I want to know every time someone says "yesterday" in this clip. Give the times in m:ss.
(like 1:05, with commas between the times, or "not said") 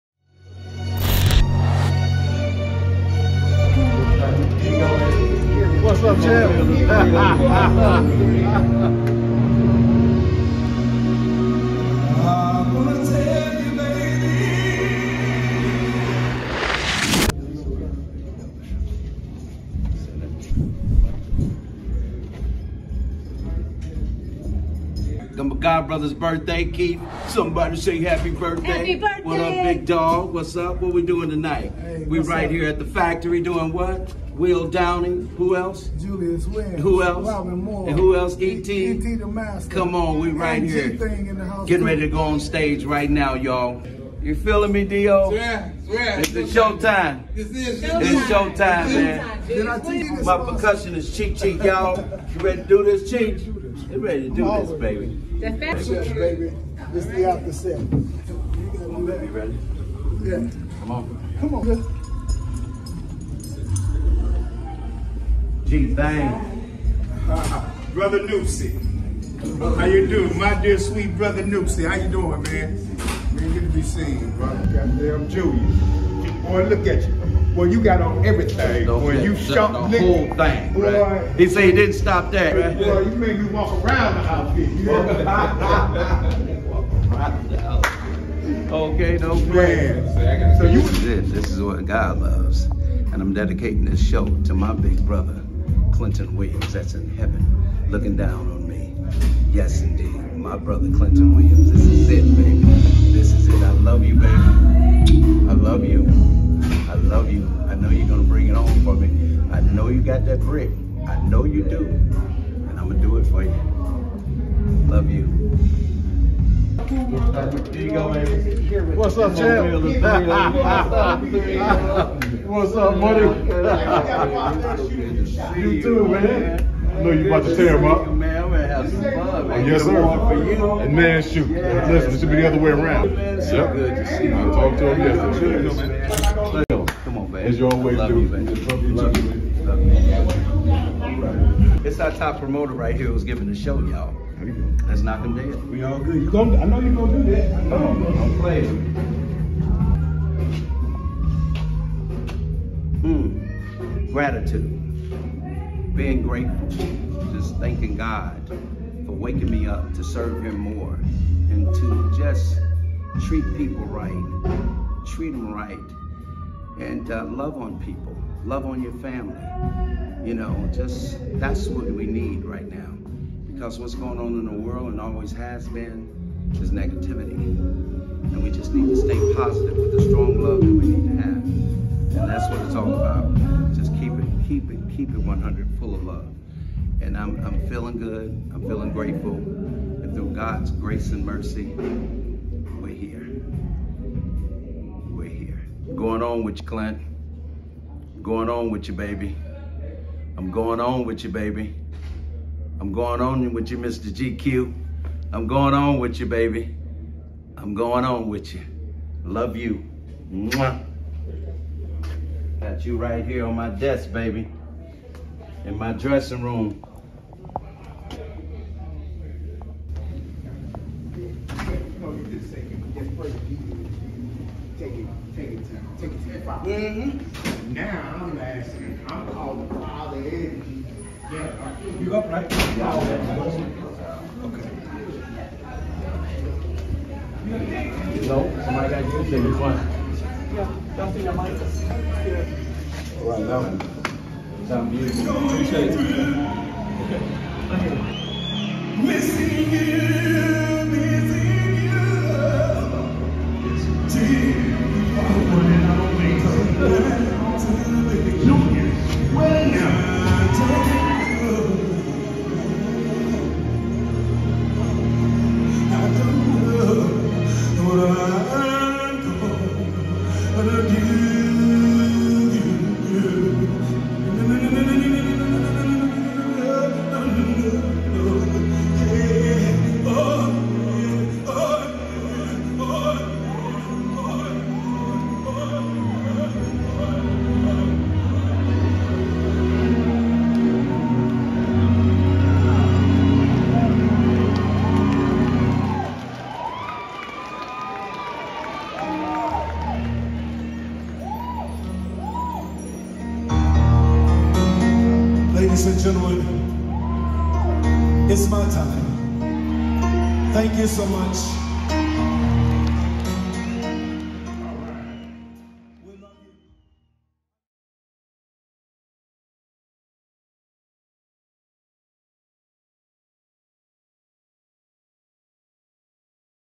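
2:15.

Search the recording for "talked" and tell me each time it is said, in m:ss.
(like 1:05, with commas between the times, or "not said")
2:14.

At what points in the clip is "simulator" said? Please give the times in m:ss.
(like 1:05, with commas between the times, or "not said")
not said.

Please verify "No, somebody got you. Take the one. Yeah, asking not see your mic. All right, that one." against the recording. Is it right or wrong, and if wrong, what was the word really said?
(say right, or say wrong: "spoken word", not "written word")
wrong: "jumping", not "asking".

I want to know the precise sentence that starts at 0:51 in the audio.
You ready to do this, Cheek?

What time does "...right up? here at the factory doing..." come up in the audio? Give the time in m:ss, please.
0:32.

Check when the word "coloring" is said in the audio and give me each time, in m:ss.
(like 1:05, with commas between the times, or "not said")
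not said.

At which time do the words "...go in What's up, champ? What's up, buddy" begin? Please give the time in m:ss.
1:57.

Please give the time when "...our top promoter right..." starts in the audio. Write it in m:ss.
2:22.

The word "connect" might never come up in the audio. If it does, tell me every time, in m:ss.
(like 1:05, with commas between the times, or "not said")
not said.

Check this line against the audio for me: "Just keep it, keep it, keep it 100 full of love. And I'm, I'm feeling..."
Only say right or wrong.
right.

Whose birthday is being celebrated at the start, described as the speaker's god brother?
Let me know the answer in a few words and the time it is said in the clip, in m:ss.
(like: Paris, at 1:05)
Keith, at 0:26.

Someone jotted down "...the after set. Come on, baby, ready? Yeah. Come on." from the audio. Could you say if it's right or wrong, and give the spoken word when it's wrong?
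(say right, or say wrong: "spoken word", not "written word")
right.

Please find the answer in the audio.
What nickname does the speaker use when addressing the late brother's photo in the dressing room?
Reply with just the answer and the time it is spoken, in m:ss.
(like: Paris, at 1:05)
Mr. GQ, at 3:23.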